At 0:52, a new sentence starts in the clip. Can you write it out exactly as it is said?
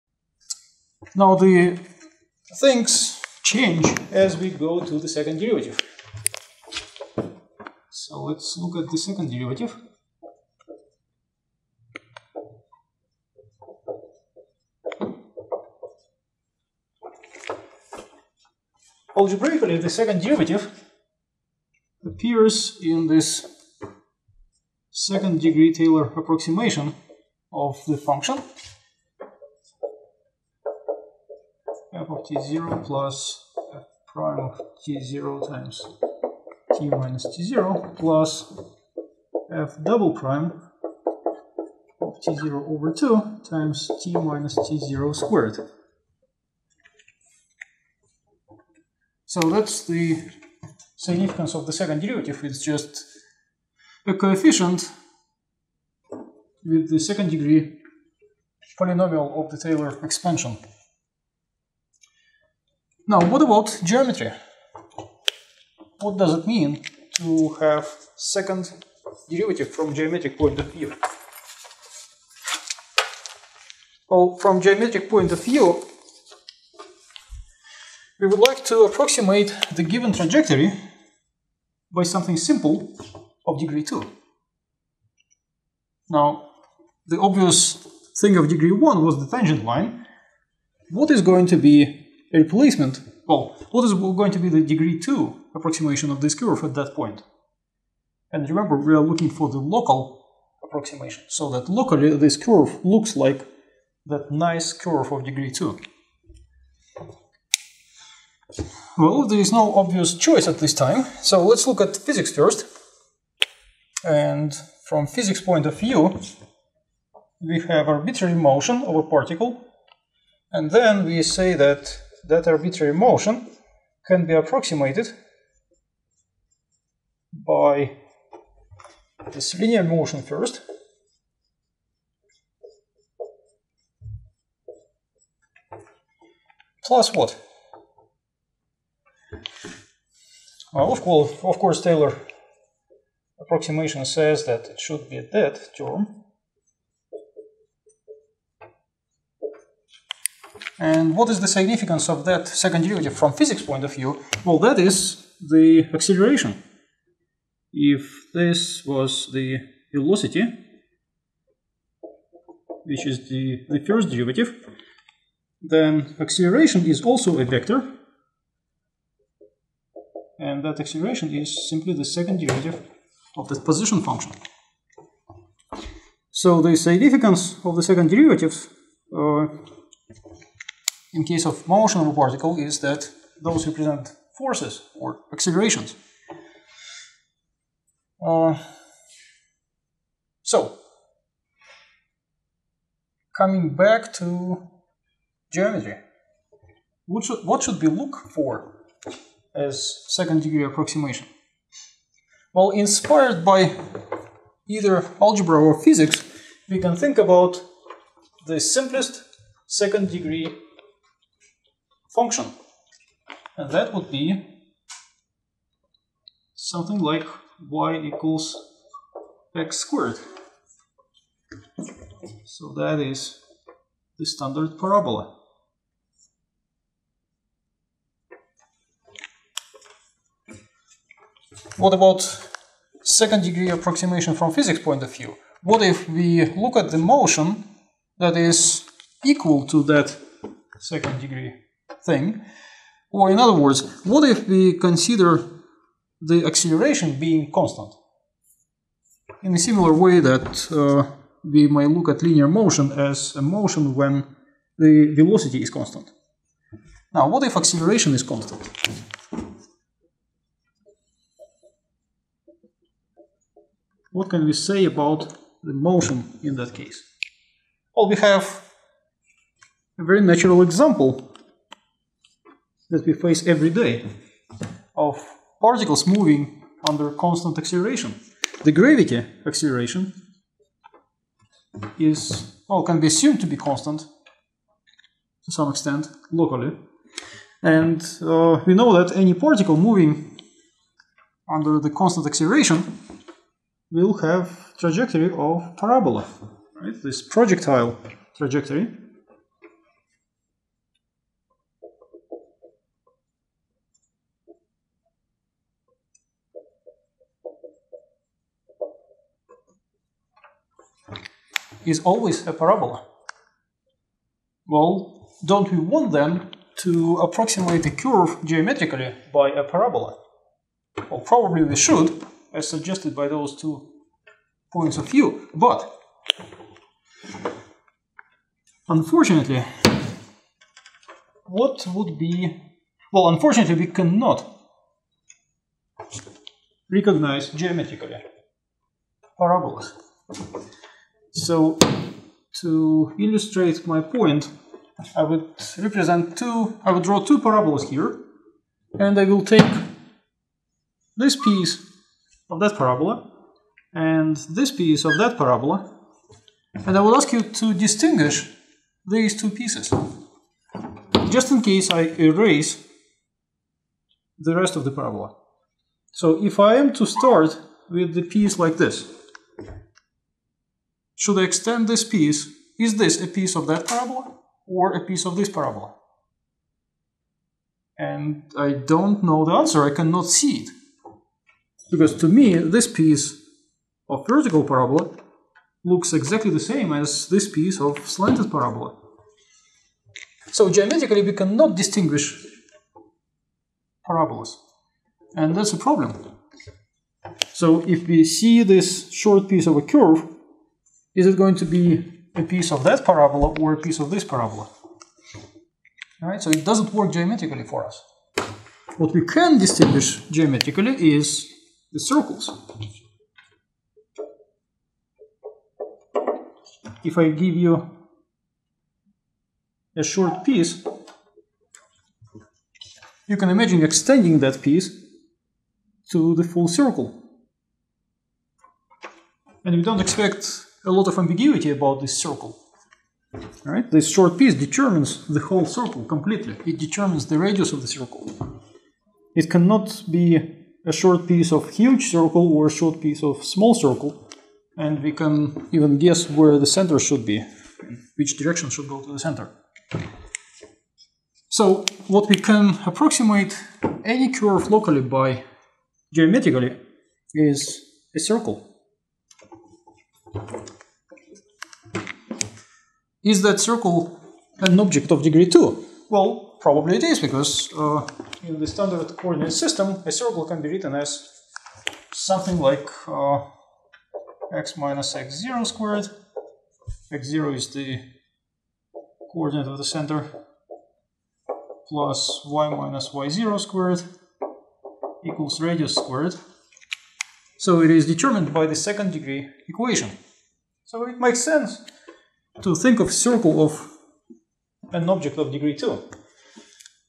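It's just a coefficient with the second degree polynomial of the Taylor expansion.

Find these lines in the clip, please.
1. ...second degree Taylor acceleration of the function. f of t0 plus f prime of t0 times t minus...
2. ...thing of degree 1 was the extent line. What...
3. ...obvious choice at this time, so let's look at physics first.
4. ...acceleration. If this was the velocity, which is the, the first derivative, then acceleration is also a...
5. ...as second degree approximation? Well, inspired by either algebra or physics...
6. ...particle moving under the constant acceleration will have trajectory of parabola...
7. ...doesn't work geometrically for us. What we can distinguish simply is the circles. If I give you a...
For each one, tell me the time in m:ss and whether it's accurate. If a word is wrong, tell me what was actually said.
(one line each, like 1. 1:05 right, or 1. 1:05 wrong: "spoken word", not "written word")
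1. 0:24 wrong: "approximation", not "acceleration"
2. 1:28 wrong: "tangent", not "extent"
3. 1:49 right
4. 2:35 right
5. 3:19 right
6. 4:49 right
7. 6:46 wrong: "geometrically", not "simply".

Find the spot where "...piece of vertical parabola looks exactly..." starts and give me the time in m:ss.
6:22.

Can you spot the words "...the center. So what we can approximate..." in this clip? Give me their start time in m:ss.
7:29.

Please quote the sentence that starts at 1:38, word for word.
And remember, we are looking for the local approximation, so that locally this curve looks like that nice curve of degree 2.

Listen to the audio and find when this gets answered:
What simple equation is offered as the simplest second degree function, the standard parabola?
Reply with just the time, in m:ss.
3:37.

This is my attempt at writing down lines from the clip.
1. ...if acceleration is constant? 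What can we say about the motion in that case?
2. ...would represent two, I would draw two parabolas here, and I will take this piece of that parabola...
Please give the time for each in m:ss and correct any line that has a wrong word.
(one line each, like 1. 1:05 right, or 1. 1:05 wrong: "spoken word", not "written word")
1. 4:17 right
2. 5:45 right.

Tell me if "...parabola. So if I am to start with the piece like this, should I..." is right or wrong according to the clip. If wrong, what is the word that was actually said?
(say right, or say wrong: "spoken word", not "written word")
right.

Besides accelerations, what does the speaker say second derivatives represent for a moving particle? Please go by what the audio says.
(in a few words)
forces.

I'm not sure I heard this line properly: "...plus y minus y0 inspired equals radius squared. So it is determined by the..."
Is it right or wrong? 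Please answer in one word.
wrong.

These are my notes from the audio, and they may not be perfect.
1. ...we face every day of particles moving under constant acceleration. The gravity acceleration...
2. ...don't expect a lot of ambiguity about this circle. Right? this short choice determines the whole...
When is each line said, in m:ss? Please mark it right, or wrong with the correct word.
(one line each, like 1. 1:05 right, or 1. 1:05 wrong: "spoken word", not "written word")
1. 4:33 right
2. 7:09 wrong: "piece", not "choice".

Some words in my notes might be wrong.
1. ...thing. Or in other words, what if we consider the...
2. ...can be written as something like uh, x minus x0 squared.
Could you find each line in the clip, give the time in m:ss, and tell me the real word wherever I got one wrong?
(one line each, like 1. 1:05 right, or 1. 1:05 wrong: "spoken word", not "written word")
1. 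4:02 right
2. 7:50 right.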